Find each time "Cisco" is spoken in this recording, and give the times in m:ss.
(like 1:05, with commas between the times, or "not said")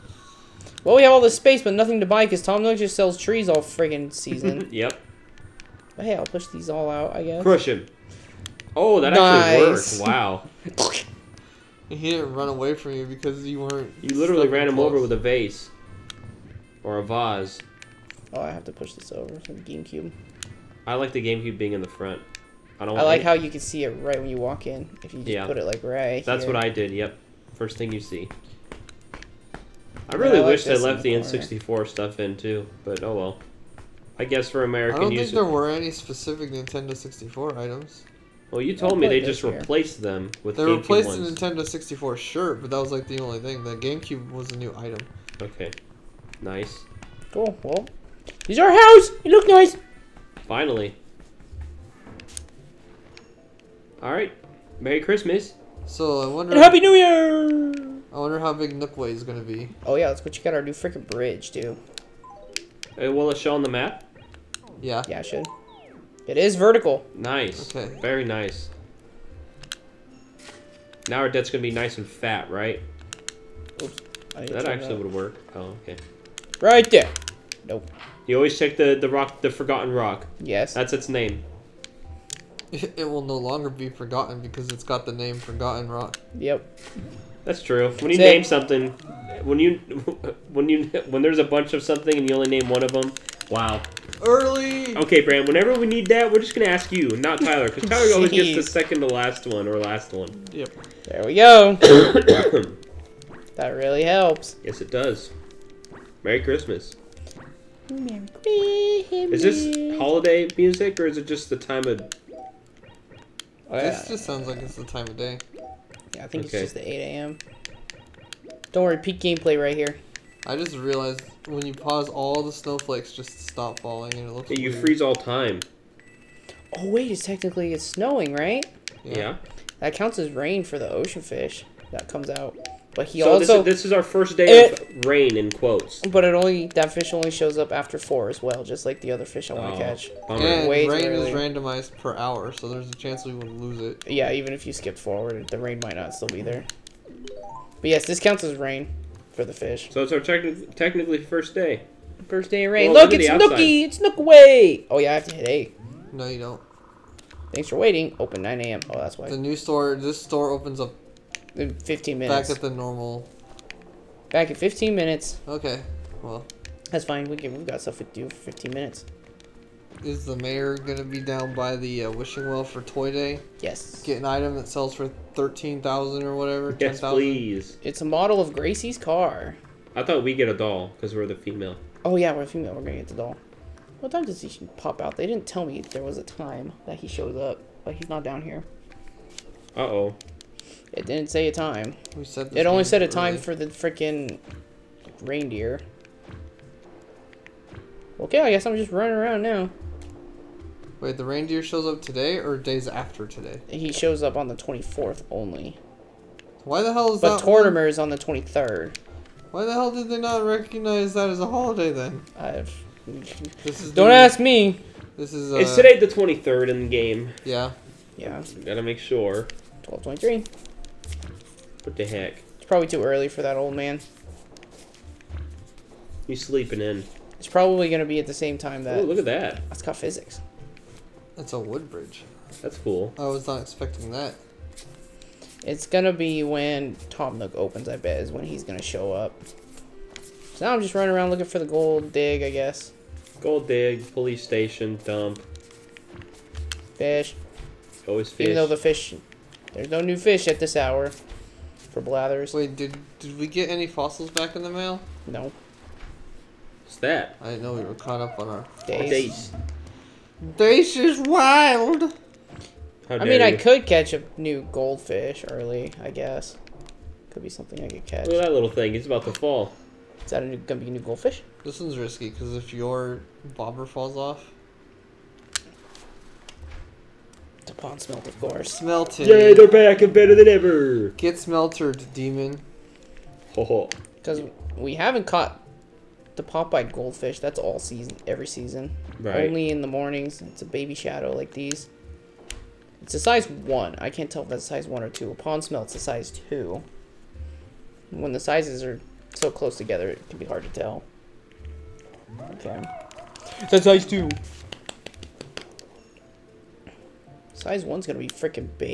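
not said.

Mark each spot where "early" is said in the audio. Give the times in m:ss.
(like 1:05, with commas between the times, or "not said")
1:34, 3:13, 3:43, 4:25.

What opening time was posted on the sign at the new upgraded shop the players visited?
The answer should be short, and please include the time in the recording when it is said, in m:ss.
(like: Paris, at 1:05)
9 a.m., at 2:38.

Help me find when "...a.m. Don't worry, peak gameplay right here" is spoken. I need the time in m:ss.
1:57.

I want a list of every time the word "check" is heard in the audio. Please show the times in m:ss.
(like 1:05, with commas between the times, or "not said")
1:00, 1:18.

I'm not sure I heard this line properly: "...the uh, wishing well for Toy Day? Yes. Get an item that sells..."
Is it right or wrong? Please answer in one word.
right.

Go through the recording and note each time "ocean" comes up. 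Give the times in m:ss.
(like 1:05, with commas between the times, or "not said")
2:10.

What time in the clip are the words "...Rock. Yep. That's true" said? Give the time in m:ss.
1:25.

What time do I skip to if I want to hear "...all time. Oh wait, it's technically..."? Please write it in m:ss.
2:05.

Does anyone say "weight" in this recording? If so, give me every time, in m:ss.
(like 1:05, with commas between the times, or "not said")
not said.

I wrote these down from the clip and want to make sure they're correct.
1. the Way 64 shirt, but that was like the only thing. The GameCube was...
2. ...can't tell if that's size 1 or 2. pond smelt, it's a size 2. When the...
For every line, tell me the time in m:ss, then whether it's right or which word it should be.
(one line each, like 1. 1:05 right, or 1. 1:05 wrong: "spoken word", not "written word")
1. 0:41 wrong: "Nintendo", not "Way"
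2. 4:54 right.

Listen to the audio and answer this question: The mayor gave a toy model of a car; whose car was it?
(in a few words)
Gracie.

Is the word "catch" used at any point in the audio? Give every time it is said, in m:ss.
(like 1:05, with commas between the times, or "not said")
2:19, 4:23, 4:28.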